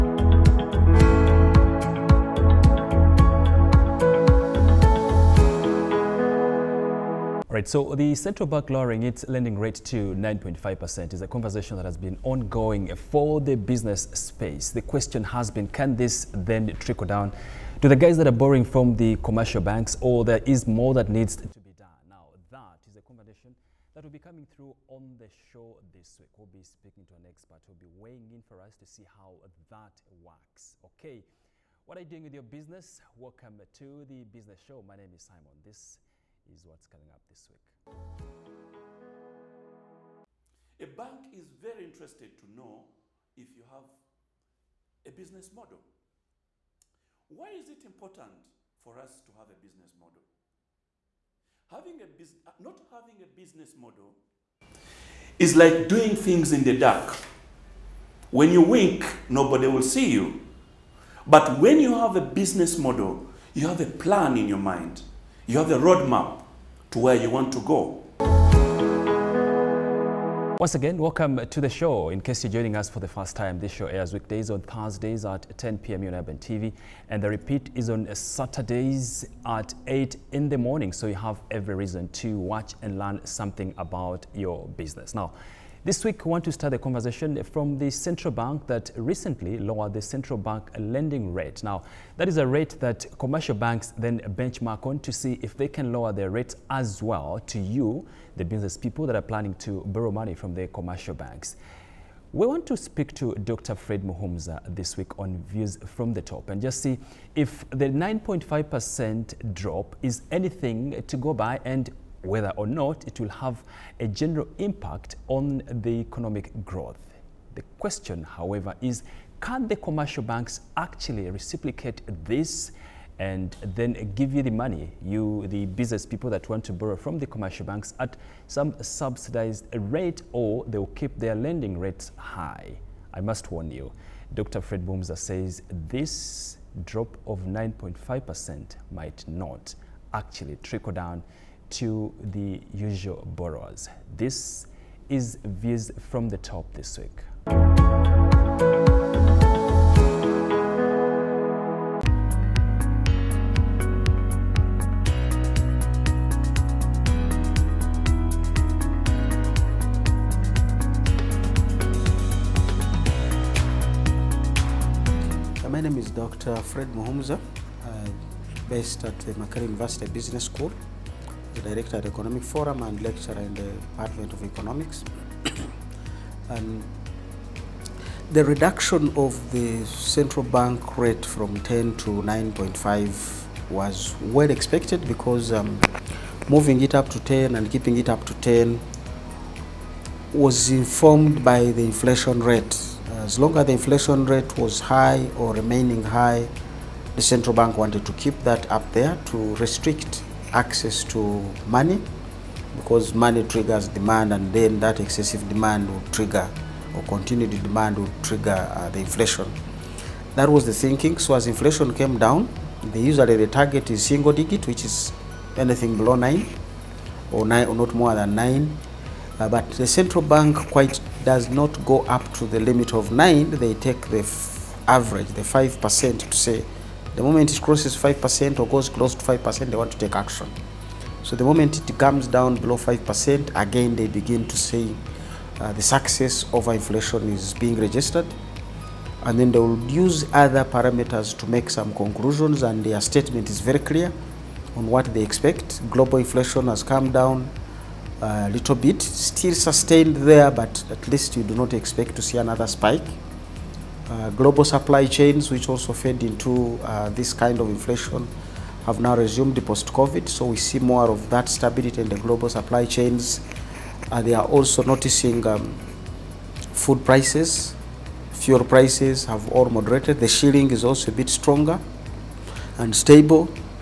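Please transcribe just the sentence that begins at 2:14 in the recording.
Fred Boomza says this drop of 9.5% might not actually trickle down to the usual borrowers.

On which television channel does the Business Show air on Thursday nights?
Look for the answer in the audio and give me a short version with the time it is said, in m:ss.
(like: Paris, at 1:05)
Urban TV, at 1:16.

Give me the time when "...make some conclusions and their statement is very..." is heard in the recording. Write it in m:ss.
4:01.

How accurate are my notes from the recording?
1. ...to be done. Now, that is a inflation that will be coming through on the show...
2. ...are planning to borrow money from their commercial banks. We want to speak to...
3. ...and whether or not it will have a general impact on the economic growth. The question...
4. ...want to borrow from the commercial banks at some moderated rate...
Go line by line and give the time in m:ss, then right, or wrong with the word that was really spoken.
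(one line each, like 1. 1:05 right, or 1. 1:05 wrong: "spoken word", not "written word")
1. 0:21 wrong: "conversation", not "inflation"
2. 1:39 right
3. 1:51 right
4. 2:06 wrong: "subsidized", not "moderated".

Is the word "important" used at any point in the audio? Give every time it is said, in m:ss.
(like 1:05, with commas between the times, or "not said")
0:47.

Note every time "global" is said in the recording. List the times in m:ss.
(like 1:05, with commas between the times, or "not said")
4:05, 4:14, 4:22.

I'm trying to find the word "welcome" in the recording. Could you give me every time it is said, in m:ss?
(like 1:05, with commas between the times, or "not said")
0:33, 1:10.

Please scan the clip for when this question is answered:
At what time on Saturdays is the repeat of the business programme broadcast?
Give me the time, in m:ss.
1:19.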